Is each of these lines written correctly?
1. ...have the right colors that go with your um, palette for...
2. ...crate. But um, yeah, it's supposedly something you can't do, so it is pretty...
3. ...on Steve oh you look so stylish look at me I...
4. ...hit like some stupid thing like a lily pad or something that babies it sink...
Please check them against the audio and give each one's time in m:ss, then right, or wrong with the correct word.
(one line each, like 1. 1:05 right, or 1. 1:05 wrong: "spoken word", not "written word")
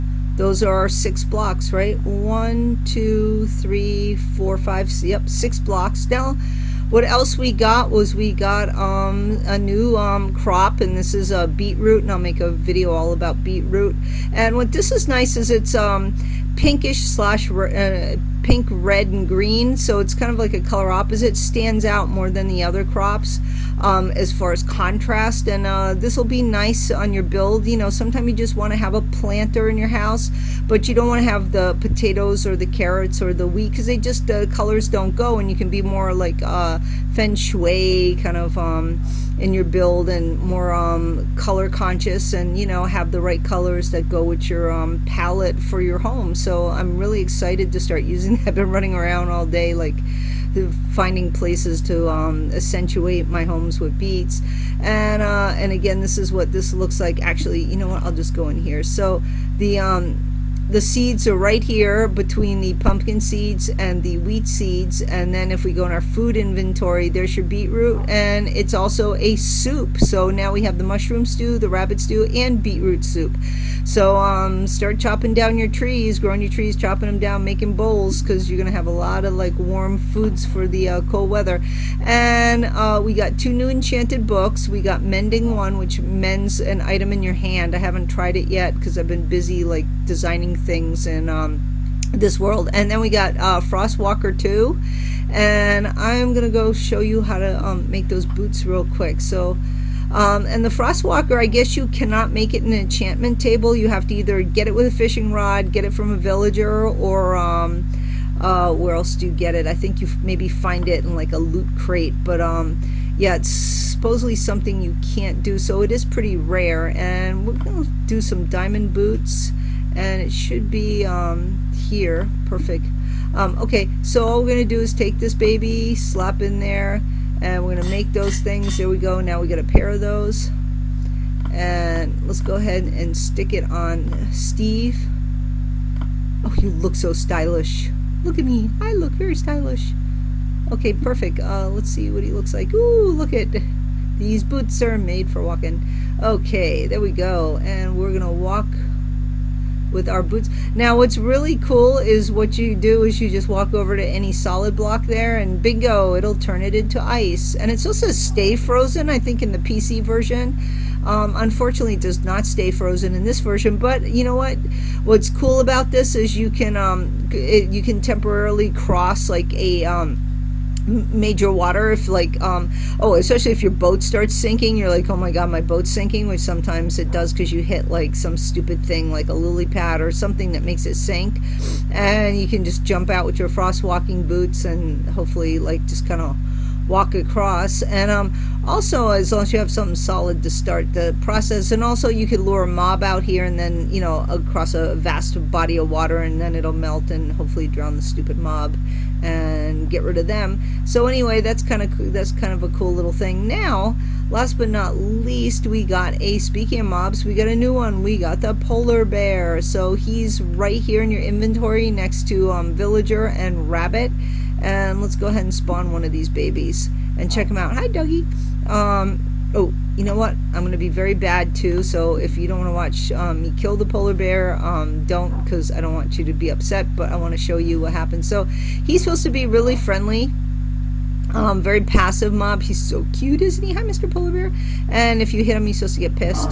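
1. 0:42 right
2. 1:51 right
3. 2:13 right
4. 2:57 wrong: "makes", not "babies".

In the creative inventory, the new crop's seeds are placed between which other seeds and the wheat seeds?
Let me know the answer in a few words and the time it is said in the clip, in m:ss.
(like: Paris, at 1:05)
Pumpkin seeds, at 1:02.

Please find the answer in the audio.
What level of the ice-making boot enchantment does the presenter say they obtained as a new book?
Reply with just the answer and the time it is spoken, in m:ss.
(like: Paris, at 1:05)
2, at 1:33.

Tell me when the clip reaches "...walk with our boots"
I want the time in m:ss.
2:28.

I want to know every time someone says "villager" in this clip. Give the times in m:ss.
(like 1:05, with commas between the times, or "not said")
1:46, 3:32.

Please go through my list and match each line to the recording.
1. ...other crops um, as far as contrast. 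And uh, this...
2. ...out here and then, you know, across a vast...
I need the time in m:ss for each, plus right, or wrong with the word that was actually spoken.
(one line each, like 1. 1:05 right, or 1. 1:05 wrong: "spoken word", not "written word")
1. 0:22 right
2. 3:13 right.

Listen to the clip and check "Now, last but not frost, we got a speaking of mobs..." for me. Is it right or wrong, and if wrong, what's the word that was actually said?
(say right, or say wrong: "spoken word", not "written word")
wrong: "least", not "frost".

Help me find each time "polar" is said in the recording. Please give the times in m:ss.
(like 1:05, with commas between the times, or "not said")
3:28, 3:43, 3:54.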